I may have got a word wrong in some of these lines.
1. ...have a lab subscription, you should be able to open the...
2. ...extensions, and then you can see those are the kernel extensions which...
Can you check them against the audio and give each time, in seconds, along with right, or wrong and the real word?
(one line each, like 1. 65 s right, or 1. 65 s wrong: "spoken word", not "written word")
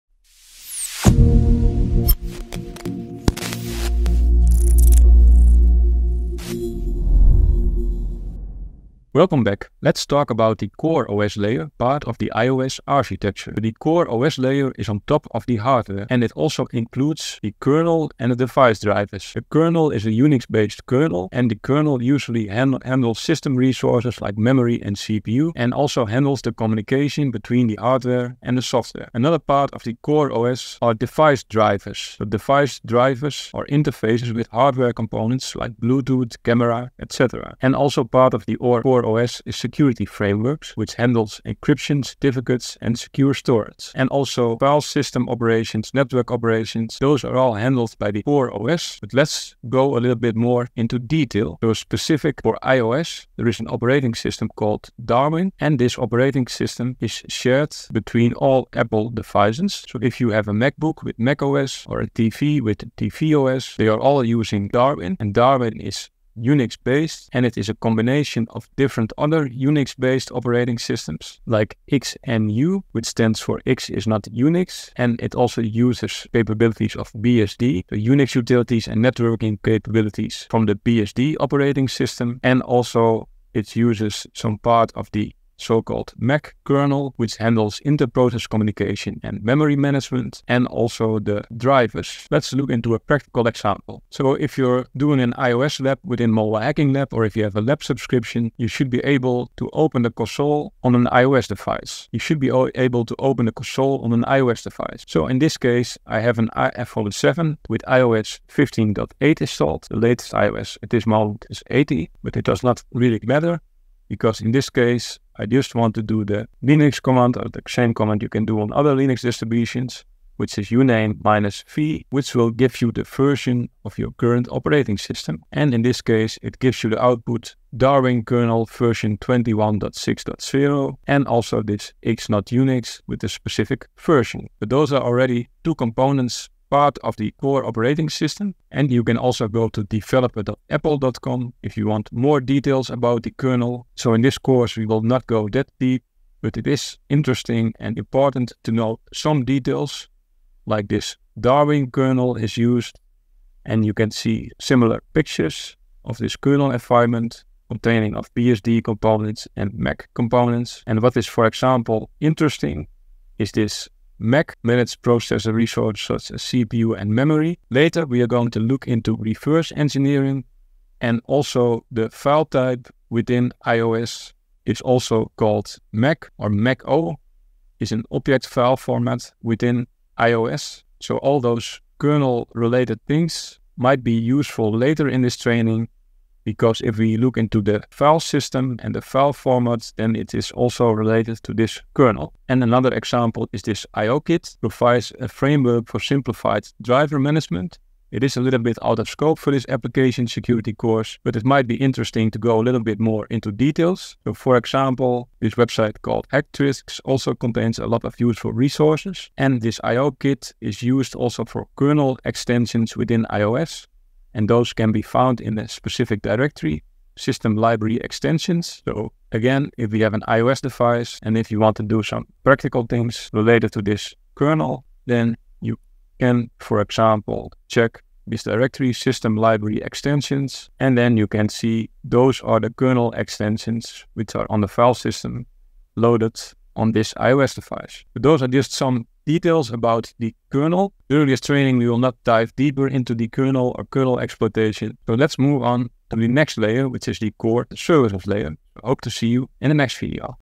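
1. 97 s right
2. 229 s right.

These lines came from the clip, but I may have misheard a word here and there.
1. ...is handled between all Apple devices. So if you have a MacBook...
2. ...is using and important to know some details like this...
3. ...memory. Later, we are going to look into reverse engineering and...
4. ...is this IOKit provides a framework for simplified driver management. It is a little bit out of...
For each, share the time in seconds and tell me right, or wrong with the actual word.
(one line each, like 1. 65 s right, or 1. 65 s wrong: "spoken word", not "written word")
1. 56 s wrong: "shared", not "handled"
2. 146 s wrong: "interesting", not "using"
3. 167 s right
4. 193 s right.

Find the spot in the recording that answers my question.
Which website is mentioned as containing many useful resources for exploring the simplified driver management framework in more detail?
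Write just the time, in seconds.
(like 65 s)
206 s.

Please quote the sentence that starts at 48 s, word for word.
But let's go a little bit more into detail.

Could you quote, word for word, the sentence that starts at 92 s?
Let's look into a practical example.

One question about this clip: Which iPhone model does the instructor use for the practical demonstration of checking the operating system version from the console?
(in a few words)
iPhone 7.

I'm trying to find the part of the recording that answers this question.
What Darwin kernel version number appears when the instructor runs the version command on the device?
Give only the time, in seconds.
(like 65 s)
129 s.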